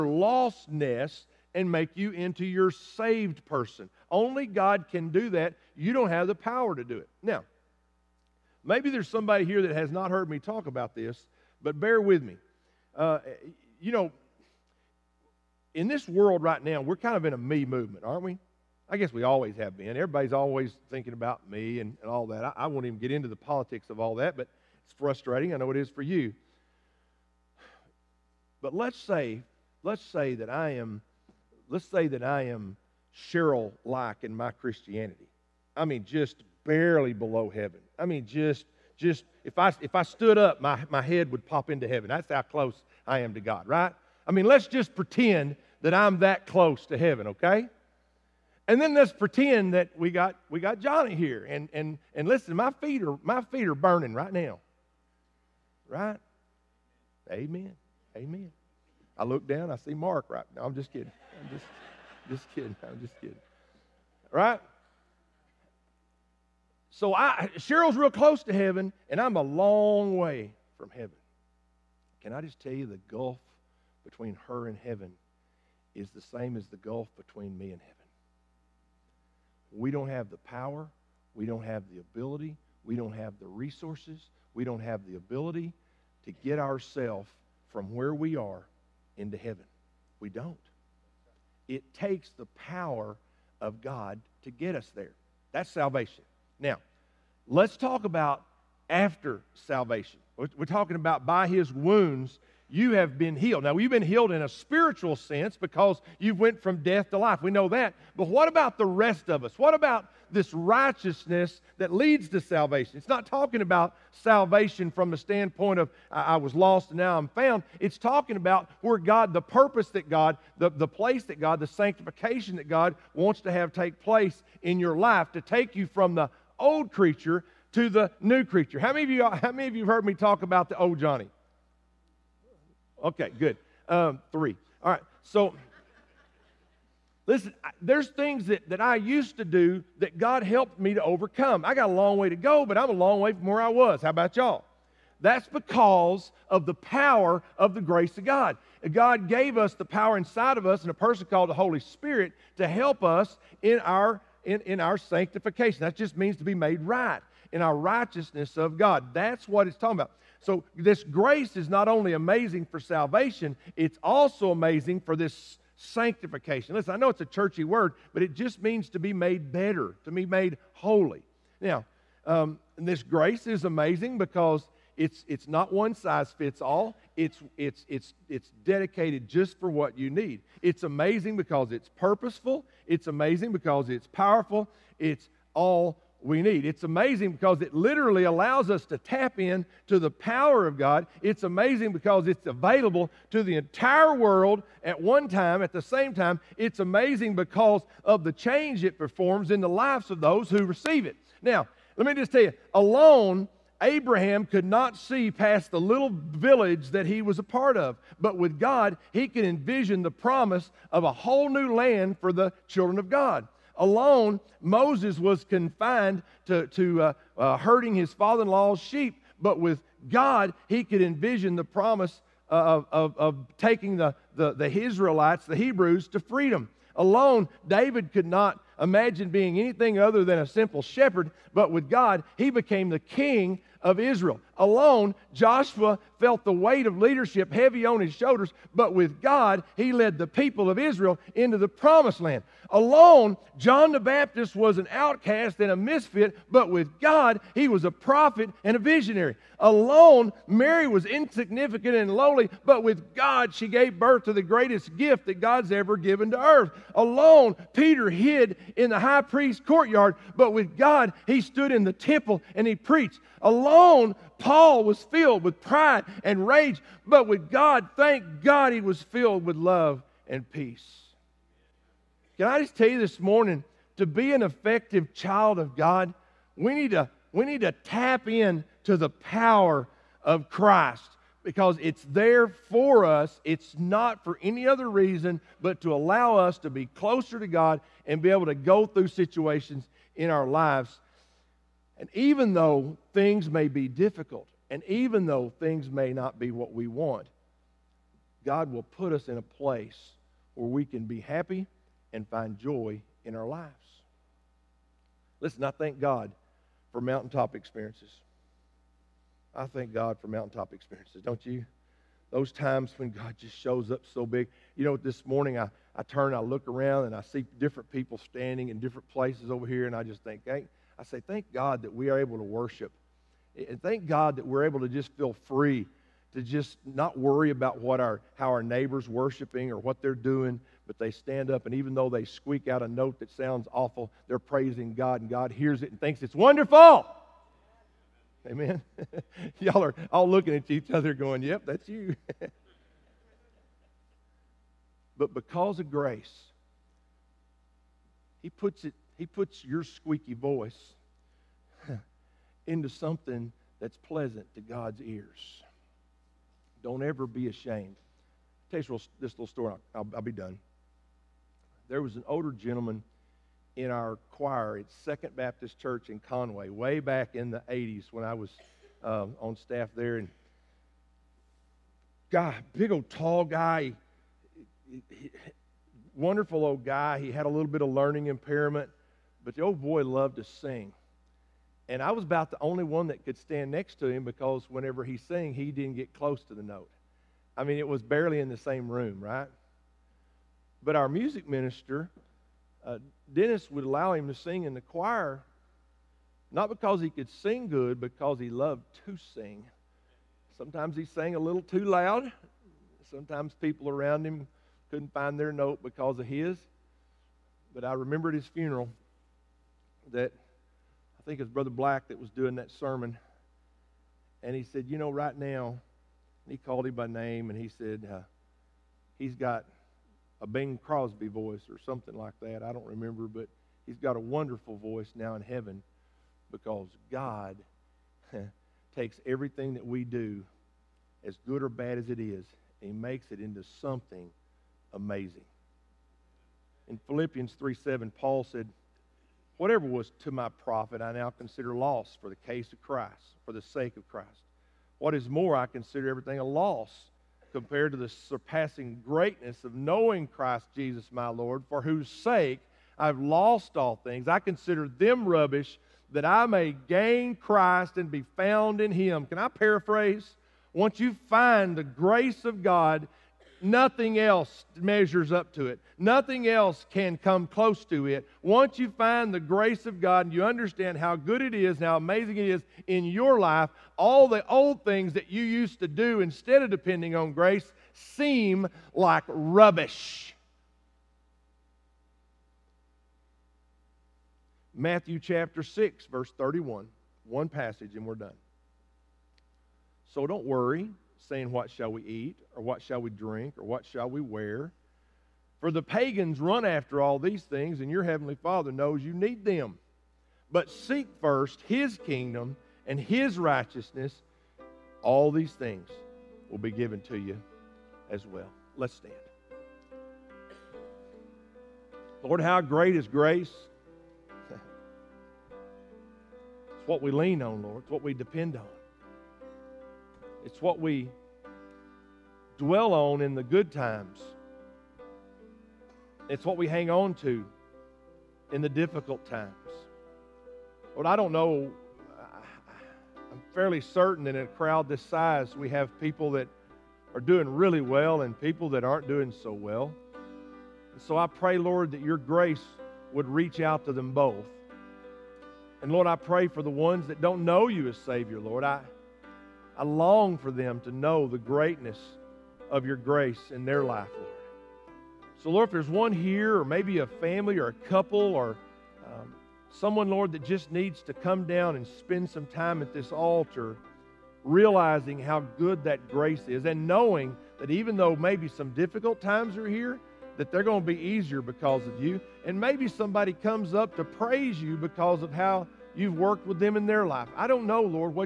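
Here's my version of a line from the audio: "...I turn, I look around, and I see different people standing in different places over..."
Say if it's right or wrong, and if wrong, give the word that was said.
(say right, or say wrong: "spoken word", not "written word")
right.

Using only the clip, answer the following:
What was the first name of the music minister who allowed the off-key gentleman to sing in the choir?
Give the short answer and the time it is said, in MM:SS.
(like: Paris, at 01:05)
Dennis, at 06:33.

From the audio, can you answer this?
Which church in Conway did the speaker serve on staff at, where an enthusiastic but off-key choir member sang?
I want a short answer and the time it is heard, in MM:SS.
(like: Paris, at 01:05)
Second Baptist Church, at 06:05.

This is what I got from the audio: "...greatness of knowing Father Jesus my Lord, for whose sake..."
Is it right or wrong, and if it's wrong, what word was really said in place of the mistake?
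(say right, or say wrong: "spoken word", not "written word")
wrong: "Christ", not "Father".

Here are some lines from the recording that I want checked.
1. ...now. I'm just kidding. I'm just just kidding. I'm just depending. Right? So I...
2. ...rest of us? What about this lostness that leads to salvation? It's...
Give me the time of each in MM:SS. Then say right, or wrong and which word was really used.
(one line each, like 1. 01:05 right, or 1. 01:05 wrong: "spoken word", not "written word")
1. 01:00 wrong: "kidding", not "depending"
2. 01:48 wrong: "righteousness", not "lostness".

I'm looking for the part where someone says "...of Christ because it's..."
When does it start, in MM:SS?
04:40.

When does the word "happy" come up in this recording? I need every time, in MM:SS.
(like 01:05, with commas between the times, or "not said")
05:01.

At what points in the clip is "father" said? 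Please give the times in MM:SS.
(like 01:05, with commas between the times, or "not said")
03:38, 08:18.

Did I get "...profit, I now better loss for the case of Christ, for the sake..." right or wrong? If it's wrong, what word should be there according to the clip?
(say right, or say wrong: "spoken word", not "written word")
wrong: "consider", not "better".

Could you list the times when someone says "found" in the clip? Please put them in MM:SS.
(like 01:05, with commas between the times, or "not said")
01:57, 07:38.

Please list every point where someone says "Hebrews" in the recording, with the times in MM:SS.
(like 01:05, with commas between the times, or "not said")
03:45.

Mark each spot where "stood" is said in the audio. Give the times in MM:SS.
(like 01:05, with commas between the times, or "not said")
00:40, 04:21.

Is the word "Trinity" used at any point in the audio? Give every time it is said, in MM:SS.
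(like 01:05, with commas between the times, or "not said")
not said.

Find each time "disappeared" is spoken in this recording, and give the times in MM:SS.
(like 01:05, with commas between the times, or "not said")
not said.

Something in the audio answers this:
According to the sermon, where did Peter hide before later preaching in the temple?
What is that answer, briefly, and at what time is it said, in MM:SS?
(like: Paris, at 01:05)
the high priest's courtyard, at 04:18.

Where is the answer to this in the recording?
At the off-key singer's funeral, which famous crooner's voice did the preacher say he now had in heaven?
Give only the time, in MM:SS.
07:00.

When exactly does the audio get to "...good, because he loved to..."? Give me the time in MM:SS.
06:37.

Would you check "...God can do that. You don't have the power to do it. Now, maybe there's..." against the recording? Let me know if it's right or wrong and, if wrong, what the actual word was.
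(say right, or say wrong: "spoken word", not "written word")
right.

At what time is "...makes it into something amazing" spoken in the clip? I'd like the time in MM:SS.
07:12.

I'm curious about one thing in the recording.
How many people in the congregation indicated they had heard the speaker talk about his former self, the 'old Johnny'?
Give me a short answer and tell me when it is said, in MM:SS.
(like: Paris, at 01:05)
3, at 02:14.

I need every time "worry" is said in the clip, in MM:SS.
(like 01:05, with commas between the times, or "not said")
05:27, 08:10.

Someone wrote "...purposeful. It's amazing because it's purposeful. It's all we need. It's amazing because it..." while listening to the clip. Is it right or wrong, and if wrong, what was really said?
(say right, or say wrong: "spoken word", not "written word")
wrong: "powerful", not "purposeful".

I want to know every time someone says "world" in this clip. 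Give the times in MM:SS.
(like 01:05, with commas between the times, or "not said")
00:16, 03:14.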